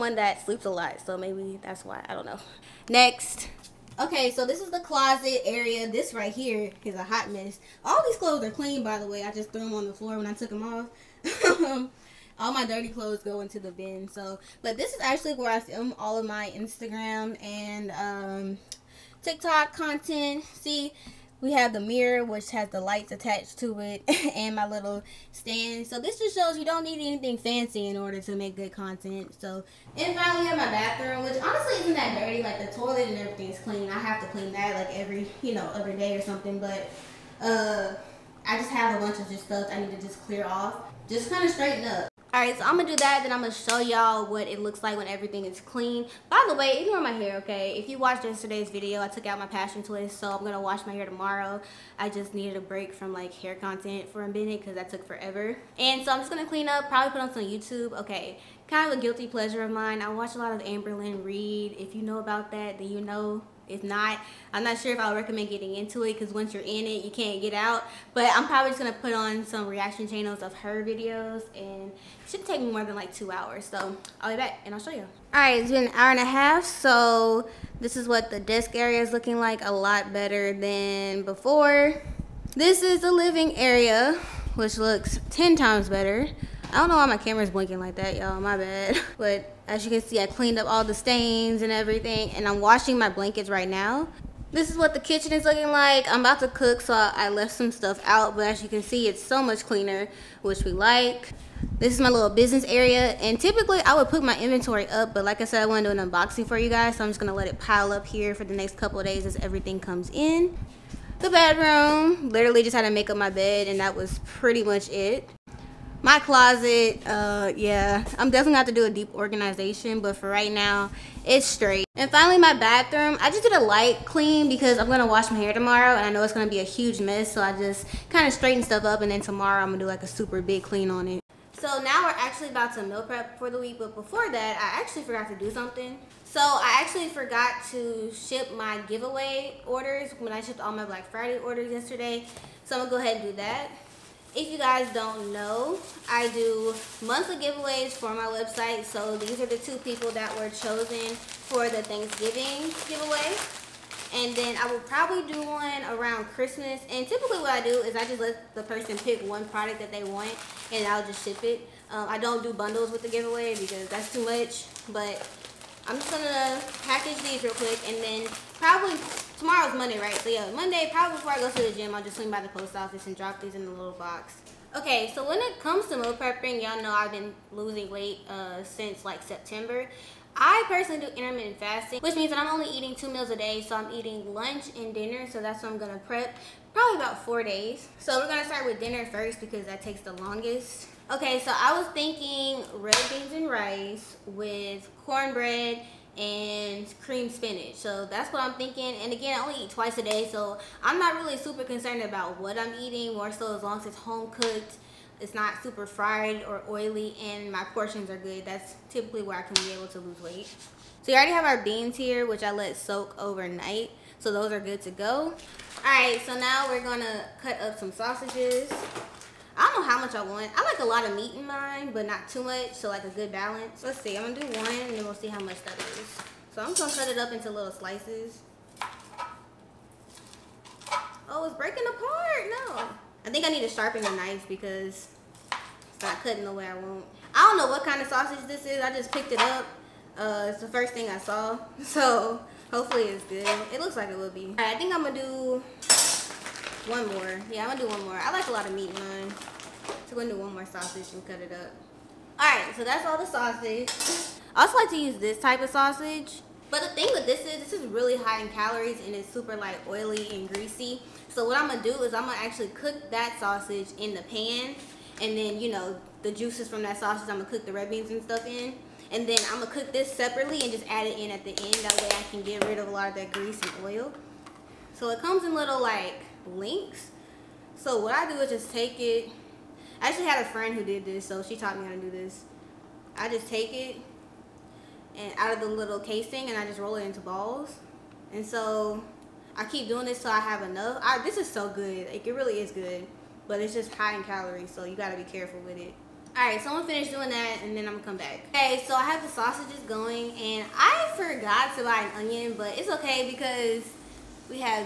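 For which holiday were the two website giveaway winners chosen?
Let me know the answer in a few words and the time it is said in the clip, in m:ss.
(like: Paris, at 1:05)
Thanksgiving, at 2:31.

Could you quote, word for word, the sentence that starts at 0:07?
All these clothes are clean, by the way.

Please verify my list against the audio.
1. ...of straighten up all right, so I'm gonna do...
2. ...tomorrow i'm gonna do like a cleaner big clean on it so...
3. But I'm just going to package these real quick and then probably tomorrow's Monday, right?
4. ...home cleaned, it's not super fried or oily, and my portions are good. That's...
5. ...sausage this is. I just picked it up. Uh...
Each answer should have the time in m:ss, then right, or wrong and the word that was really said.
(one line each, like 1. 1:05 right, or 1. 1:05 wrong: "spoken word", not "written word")
1. 0:41 right
2. 2:09 wrong: "super", not "cleaner"
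3. 2:44 right
4. 3:23 wrong: "cooked", not "cleaned"
5. 3:58 right.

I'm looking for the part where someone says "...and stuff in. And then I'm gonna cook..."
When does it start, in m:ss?
4:28.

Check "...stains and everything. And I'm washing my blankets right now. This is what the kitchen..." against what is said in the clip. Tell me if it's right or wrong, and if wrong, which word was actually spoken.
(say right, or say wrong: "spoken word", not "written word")
right.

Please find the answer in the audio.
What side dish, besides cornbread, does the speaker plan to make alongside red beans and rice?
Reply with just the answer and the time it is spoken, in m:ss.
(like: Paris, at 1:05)
cream spinach, at 3:16.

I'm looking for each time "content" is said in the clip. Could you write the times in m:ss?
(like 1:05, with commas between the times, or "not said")
0:19, 0:28, 0:53.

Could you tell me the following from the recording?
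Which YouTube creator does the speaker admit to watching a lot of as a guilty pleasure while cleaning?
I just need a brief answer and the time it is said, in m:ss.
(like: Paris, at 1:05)
Amberlynn Reed, at 1:00.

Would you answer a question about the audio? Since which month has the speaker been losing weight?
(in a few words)
September.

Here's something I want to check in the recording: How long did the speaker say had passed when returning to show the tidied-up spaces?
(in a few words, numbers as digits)
an hour and a half.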